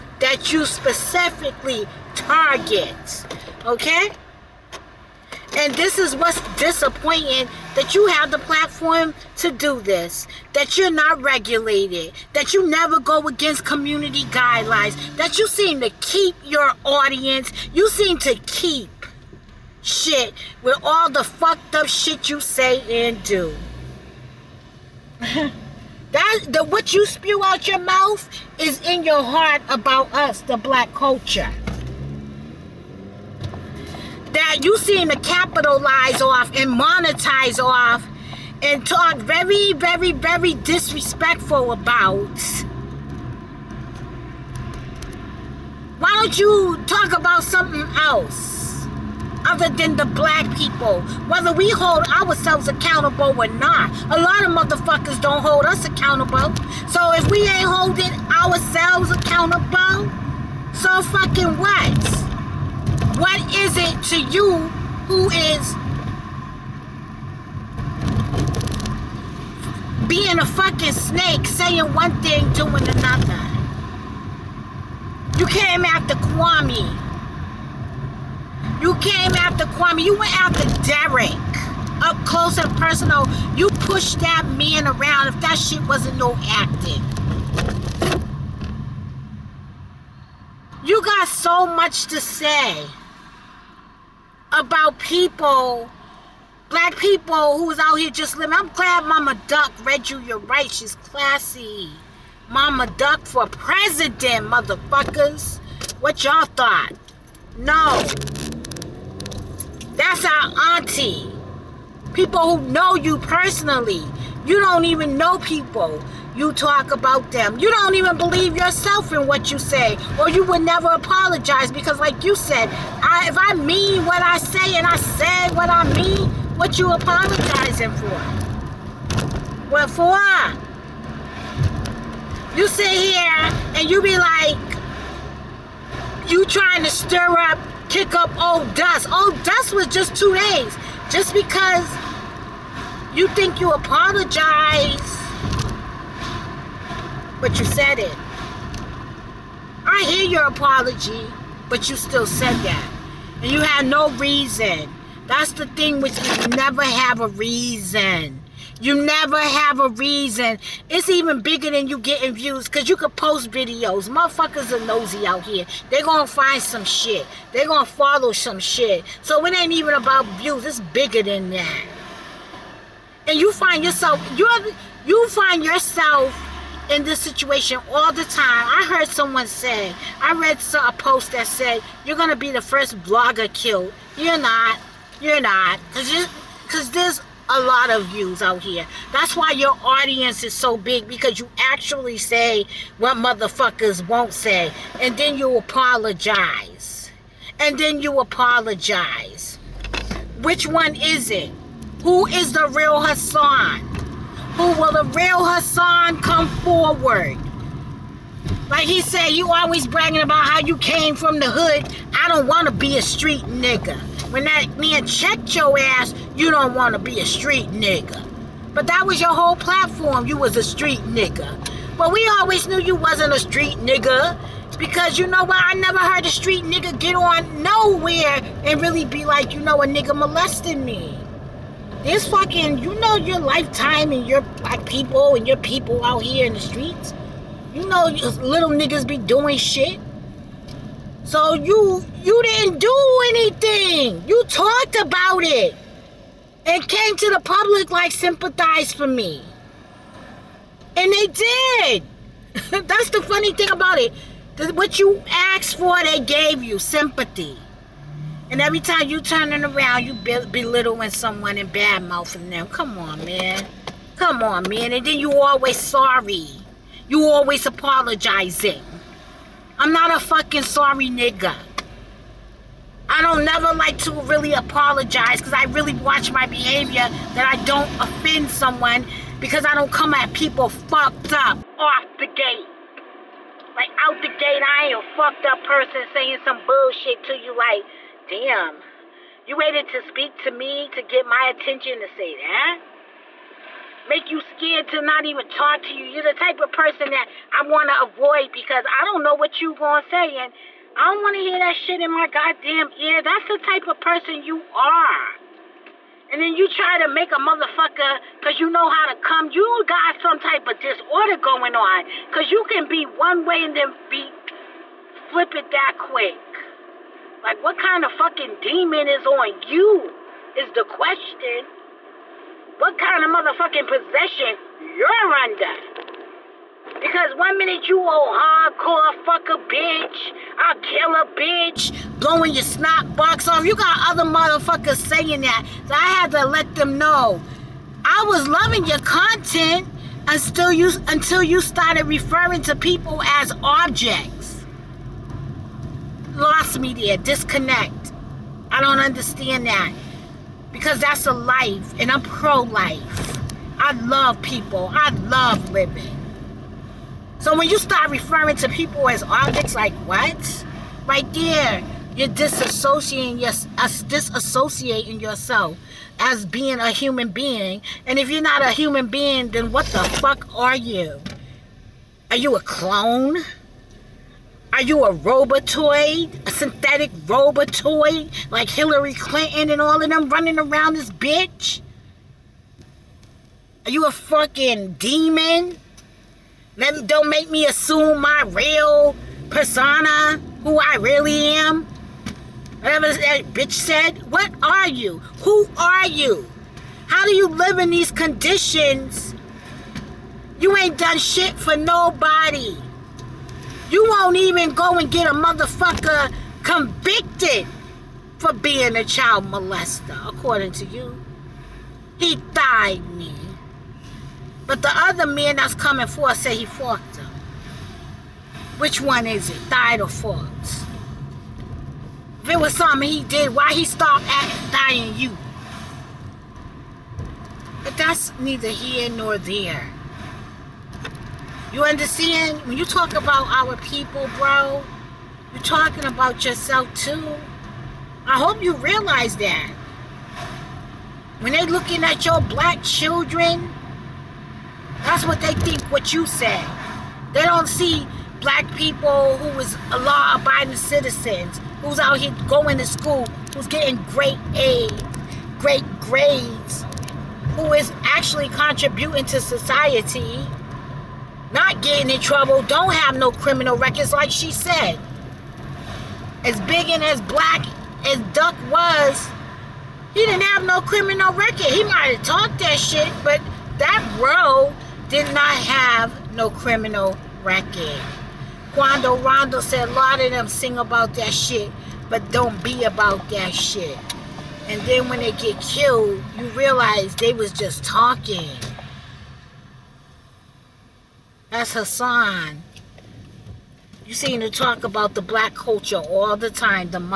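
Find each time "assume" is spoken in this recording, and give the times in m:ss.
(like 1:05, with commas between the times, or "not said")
6:27.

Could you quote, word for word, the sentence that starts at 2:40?
It's even bigger than you getting views because you could post videos.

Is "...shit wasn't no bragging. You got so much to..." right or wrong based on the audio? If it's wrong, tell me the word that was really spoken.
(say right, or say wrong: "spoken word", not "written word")
wrong: "acting", not "bragging".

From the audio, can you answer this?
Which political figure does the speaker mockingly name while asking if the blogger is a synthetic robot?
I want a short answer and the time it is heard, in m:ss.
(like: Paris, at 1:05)
Hillary Clinton, at 6:18.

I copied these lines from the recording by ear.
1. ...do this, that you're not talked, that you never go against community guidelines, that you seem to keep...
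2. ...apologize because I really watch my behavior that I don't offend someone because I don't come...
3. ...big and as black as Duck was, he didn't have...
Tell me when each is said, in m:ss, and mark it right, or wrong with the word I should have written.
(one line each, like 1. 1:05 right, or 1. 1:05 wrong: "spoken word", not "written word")
1. 0:09 wrong: "regulated", not "talked"
2. 4:34 right
3. 7:46 right.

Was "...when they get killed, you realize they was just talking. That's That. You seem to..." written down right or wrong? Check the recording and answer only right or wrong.
wrong.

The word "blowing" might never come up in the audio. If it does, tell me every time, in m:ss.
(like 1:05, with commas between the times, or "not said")
5:32.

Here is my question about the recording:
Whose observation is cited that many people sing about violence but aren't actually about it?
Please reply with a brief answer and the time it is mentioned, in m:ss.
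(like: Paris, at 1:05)
Quando Rondo, at 7:58.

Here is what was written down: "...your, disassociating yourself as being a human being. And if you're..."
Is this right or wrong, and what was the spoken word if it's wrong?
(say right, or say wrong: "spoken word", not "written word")
right.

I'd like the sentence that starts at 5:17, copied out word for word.
Like, what kind of fucking demon is on you?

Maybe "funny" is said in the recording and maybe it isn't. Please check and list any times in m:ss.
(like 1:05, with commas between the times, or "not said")
4:13.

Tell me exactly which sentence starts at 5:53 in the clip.
I love people, I love living.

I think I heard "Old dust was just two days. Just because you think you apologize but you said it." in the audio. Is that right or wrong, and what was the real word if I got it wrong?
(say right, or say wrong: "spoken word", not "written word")
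right.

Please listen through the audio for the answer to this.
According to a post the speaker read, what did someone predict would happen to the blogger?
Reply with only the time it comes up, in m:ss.
3:02.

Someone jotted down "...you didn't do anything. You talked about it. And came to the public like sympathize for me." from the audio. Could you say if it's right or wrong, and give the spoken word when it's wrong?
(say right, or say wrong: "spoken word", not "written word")
right.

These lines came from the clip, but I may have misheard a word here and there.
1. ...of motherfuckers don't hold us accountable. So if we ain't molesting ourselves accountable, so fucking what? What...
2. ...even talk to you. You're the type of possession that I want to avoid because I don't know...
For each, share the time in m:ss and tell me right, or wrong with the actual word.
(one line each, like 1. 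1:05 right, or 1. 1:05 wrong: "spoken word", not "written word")
1. 0:54 wrong: "holding", not "molesting"
2. 4:55 wrong: "person", not "possession".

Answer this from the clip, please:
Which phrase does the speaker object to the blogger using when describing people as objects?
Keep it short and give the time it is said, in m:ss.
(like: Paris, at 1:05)
lost media, at 5:46.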